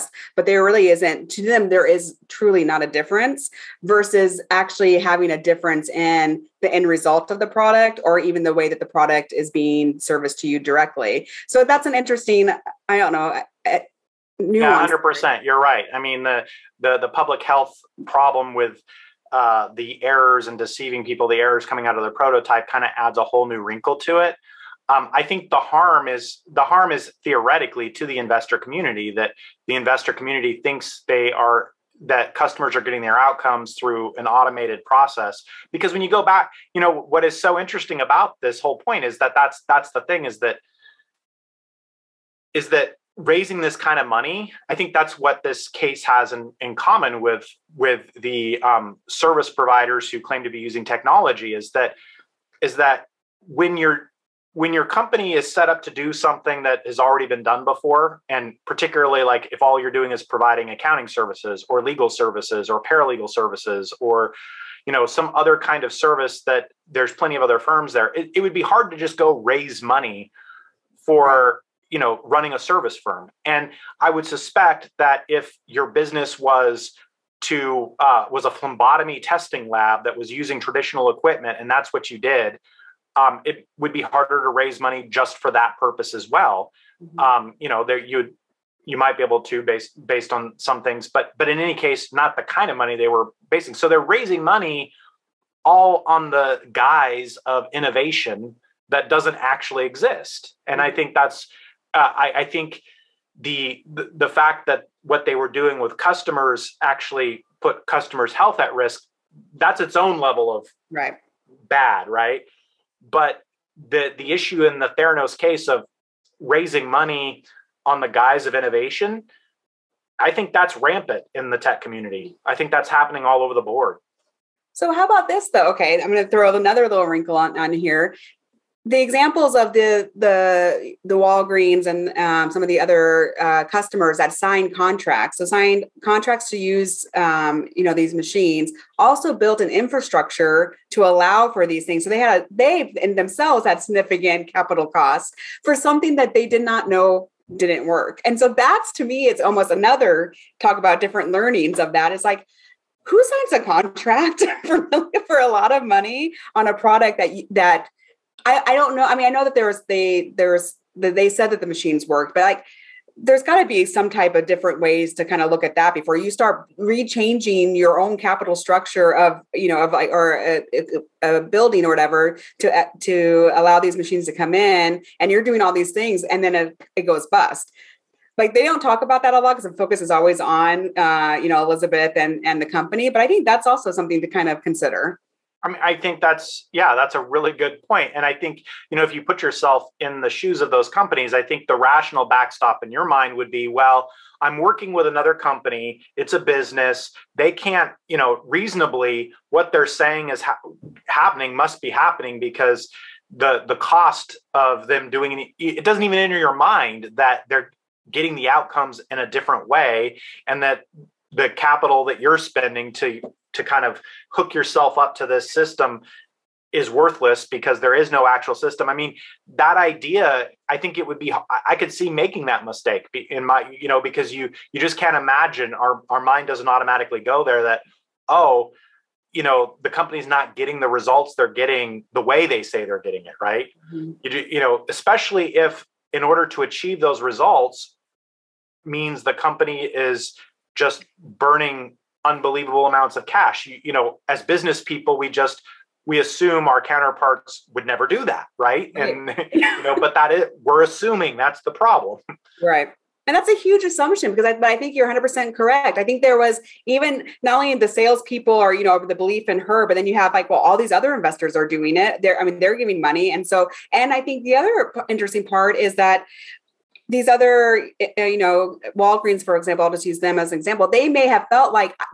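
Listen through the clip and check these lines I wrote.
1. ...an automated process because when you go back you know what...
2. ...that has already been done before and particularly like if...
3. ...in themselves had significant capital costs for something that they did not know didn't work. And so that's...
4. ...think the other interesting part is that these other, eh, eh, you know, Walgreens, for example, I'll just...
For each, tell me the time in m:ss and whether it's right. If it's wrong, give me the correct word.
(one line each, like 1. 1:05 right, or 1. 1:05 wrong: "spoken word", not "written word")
1. 0:34 right
2. 0:56 right
3. 2:23 right
4. 4:24 right.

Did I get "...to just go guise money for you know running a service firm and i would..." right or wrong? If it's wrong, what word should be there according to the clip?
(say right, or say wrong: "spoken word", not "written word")
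wrong: "raise", not "guise".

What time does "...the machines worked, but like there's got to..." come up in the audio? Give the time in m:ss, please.
2:41.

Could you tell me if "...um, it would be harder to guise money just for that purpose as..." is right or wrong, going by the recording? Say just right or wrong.
wrong.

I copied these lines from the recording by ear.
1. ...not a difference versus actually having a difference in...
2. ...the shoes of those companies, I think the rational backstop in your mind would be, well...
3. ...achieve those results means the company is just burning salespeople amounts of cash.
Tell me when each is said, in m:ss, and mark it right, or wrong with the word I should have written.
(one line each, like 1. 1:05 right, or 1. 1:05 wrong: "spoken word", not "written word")
1. 0:02 right
2. 3:10 right
3. 3:56 wrong: "unbelievable", not "salespeople".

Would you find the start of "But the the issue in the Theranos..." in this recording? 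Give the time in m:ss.
1:53.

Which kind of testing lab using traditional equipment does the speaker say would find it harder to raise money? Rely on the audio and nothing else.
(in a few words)
phlebotomy testing lab.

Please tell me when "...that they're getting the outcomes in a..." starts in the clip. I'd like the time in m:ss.
3:27.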